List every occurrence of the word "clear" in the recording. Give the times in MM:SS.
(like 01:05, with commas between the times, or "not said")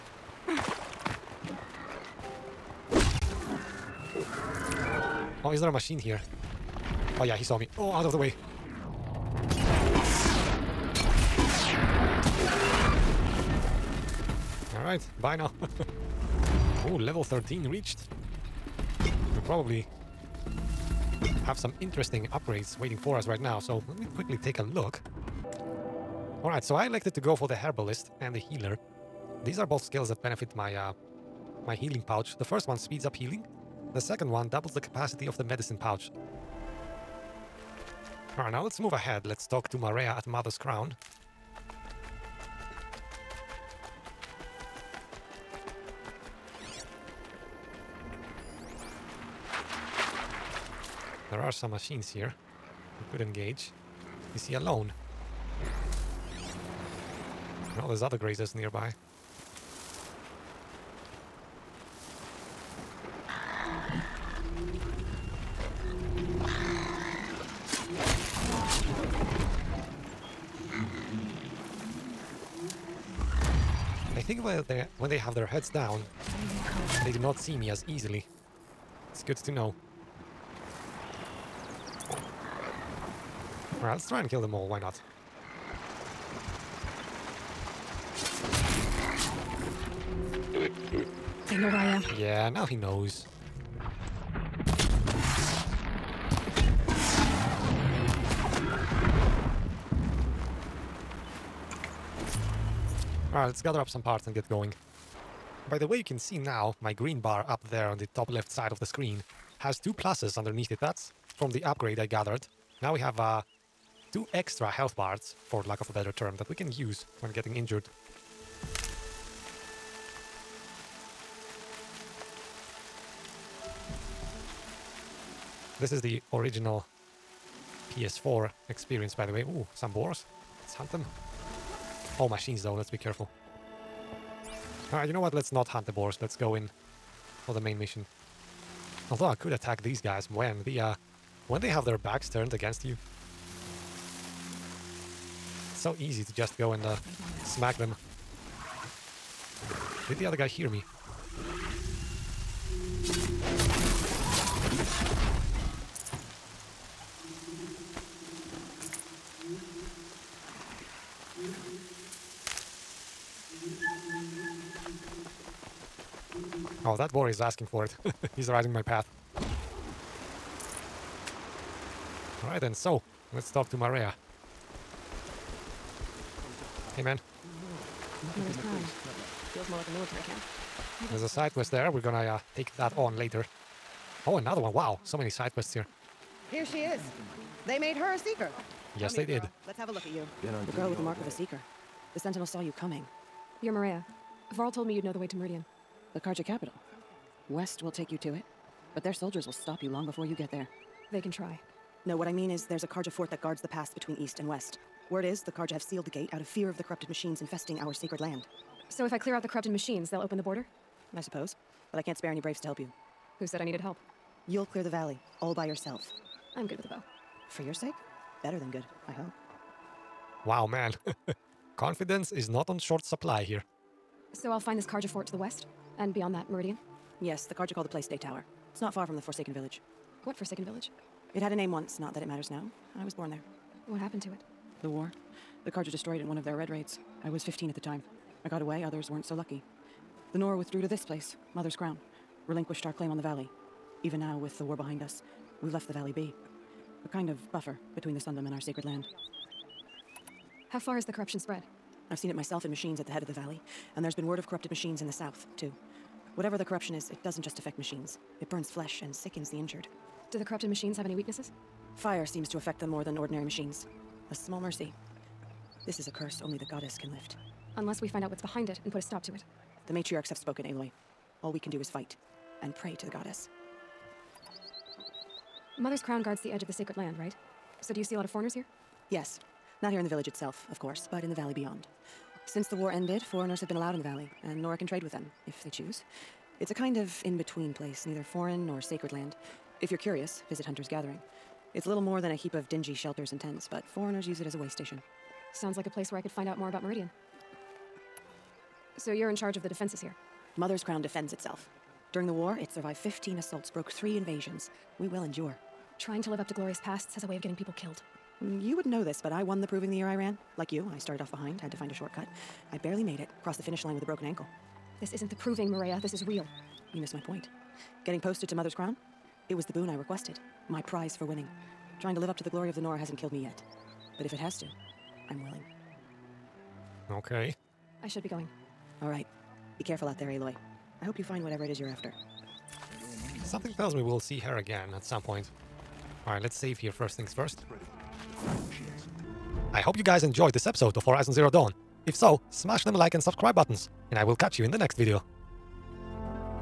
03:29, 03:34.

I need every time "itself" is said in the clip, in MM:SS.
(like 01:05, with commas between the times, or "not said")
04:40, 05:01.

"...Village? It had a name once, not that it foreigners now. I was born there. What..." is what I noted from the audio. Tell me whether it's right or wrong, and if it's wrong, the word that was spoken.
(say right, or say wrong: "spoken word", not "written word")
wrong: "matters", not "foreigners".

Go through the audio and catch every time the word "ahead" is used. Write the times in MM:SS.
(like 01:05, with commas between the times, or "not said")
00:38.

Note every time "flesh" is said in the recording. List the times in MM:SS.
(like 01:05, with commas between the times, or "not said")
04:18.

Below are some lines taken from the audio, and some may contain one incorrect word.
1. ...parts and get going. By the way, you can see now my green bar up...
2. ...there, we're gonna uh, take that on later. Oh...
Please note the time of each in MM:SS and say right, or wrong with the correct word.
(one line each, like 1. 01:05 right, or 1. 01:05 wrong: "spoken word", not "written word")
1. 01:44 right
2. 03:01 right.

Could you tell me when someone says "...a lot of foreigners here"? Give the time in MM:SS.
04:38.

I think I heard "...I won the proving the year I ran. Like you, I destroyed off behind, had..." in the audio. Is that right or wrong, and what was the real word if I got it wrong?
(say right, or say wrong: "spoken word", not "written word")
wrong: "started", not "destroyed".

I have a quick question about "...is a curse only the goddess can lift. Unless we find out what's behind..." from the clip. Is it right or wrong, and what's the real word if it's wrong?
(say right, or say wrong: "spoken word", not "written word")
right.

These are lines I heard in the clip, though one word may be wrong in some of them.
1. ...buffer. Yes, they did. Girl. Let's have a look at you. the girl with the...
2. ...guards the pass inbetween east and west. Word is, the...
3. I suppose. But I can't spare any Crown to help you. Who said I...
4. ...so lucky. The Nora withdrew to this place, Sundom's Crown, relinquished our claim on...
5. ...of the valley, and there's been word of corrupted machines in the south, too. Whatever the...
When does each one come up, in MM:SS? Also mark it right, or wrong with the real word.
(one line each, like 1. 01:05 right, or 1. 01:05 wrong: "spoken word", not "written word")
1. 03:08 wrong: "seeker", not "buffer"
2. 03:23 wrong: "between", not "inbetween"
3. 03:31 wrong: "Braves", not "Crown"
4. 03:59 wrong: "Mother", not "Sundom"
5. 04:13 right.